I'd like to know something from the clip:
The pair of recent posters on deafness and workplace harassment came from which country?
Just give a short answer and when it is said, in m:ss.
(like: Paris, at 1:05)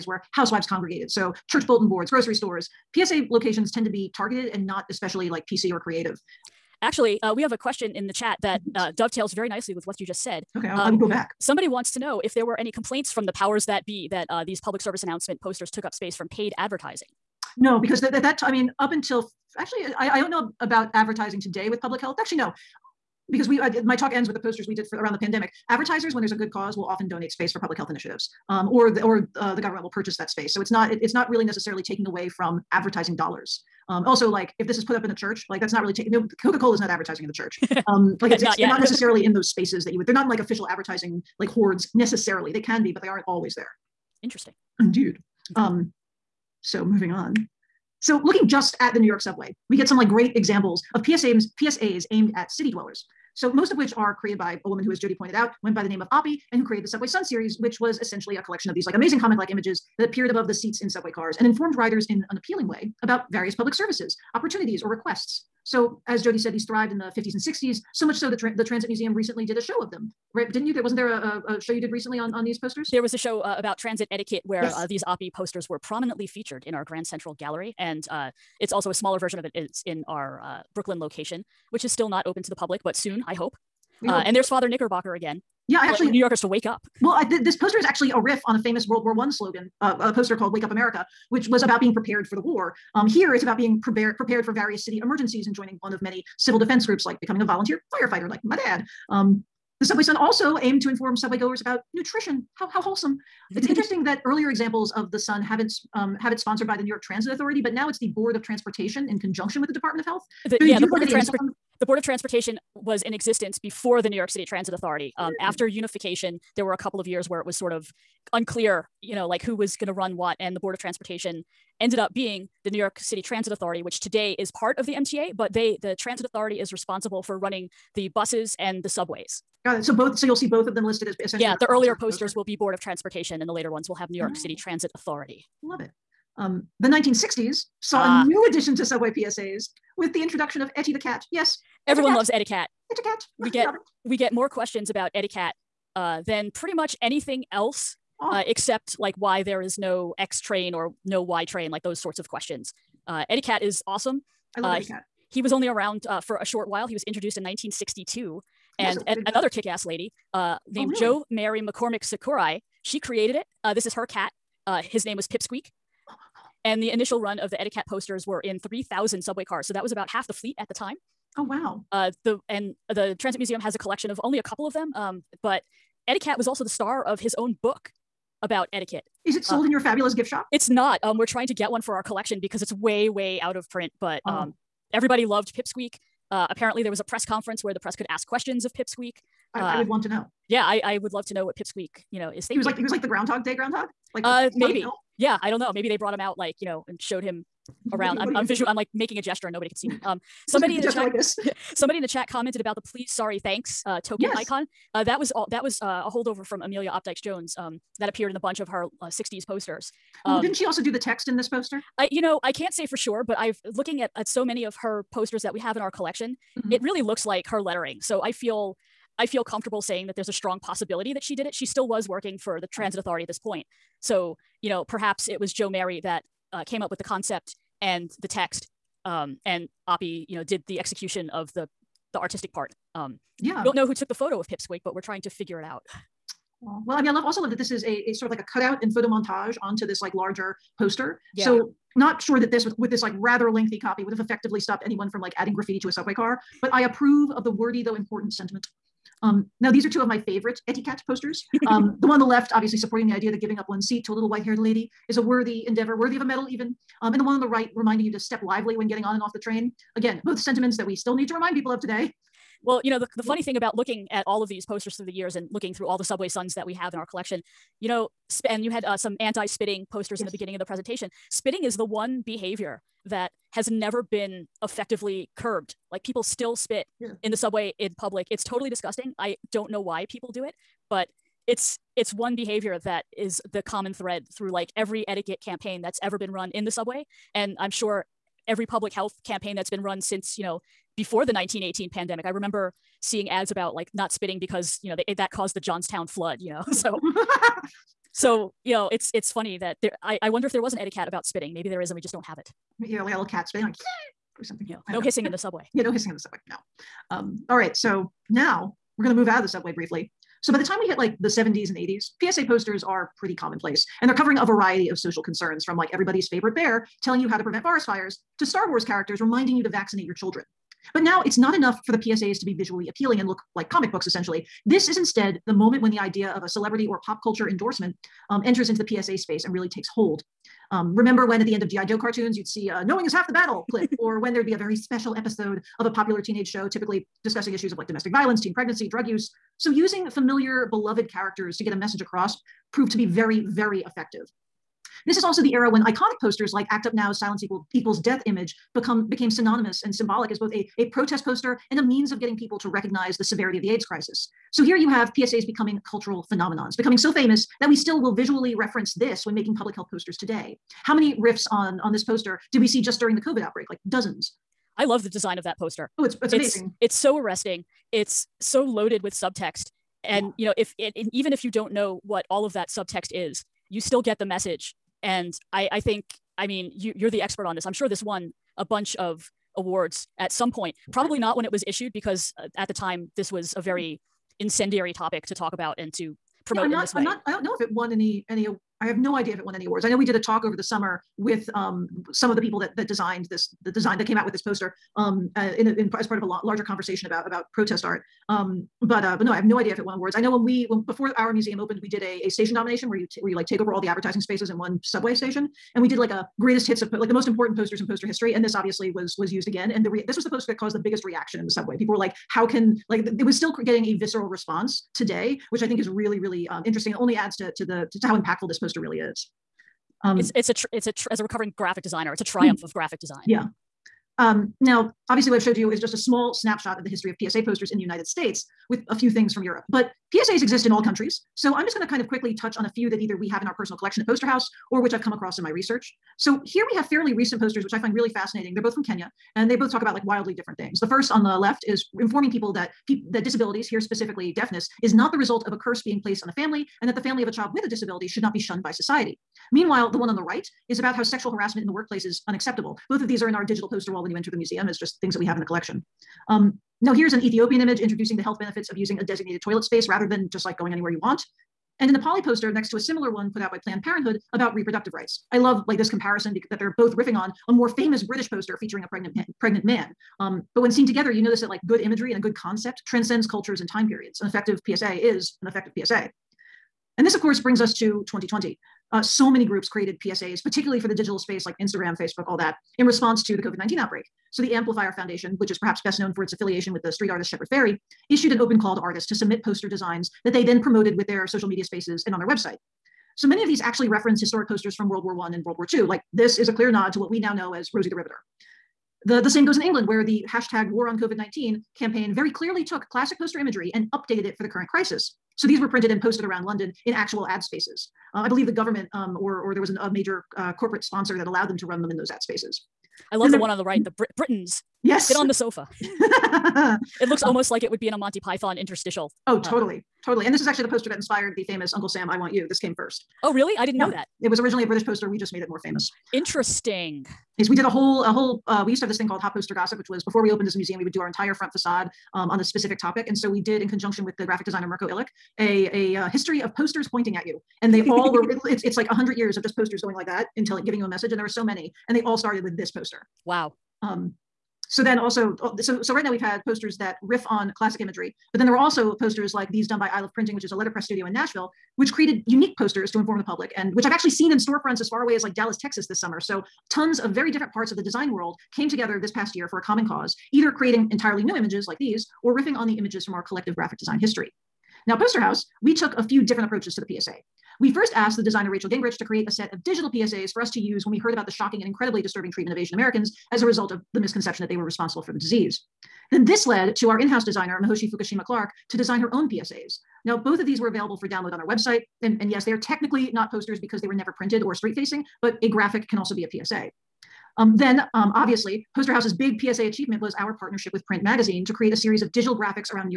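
Kenya, at 7:18.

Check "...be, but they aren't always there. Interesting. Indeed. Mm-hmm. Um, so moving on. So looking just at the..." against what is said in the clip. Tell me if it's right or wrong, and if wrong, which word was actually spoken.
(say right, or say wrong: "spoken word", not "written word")
right.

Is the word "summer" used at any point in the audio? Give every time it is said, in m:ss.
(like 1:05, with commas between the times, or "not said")
6:30, 9:15.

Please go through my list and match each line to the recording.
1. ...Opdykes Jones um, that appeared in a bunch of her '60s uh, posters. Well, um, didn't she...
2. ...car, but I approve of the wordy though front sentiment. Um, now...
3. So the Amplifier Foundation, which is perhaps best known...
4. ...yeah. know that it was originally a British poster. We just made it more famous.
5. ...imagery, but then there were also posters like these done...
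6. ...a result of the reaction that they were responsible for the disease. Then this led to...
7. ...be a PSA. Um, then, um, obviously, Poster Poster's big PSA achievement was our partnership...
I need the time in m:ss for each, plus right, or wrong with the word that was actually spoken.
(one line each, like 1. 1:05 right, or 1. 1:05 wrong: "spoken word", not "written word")
1. 3:26 right
2. 4:06 wrong: "important", not "front"
3. 8:04 right
4. 8:43 right
5. 9:07 right
6. 9:33 wrong: "misconception", not "reaction"
7. 9:46 wrong: "House", not "Poster".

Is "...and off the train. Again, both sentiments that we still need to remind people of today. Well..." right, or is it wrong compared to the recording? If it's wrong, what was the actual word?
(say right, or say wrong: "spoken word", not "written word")
right.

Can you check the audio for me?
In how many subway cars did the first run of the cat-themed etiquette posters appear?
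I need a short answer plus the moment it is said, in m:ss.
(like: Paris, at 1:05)
3,000, at 2:48.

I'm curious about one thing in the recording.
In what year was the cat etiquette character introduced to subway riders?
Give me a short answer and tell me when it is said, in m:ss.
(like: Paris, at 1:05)
1962, at 2:37.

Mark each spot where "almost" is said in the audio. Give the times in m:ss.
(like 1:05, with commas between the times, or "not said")
8:37.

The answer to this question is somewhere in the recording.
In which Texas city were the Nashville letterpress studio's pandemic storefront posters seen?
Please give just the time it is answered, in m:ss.
9:15.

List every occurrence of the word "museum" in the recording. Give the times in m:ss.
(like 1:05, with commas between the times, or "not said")
1:08, 2:53, 6:41, 7:34, 8:50.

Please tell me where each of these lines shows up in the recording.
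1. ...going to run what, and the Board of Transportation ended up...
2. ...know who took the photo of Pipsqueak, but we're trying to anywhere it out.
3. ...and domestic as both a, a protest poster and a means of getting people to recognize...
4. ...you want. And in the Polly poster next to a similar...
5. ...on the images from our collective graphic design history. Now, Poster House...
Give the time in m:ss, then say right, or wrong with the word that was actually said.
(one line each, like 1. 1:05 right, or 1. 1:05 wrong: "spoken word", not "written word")
1. 1:59 right
2. 3:53 wrong: "figure", not "anywhere"
3. 5:49 wrong: "symbolic", not "domestic"
4. 7:40 right
5. 9:22 right.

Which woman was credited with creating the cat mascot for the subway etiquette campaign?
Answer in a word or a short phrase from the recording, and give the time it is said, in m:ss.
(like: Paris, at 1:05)
Jo Mary McCormick Sakurai, at 2:41.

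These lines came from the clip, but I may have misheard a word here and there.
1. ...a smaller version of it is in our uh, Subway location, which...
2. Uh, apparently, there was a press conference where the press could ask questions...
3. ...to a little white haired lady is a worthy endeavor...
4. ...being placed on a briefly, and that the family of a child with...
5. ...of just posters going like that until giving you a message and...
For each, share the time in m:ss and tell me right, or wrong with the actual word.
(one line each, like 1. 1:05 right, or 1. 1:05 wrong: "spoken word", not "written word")
1. 1:18 wrong: "Brooklyn", not "Subway"
2. 3:06 right
3. 4:14 right
4. 7:25 wrong: "family", not "briefly"
5. 8:59 right.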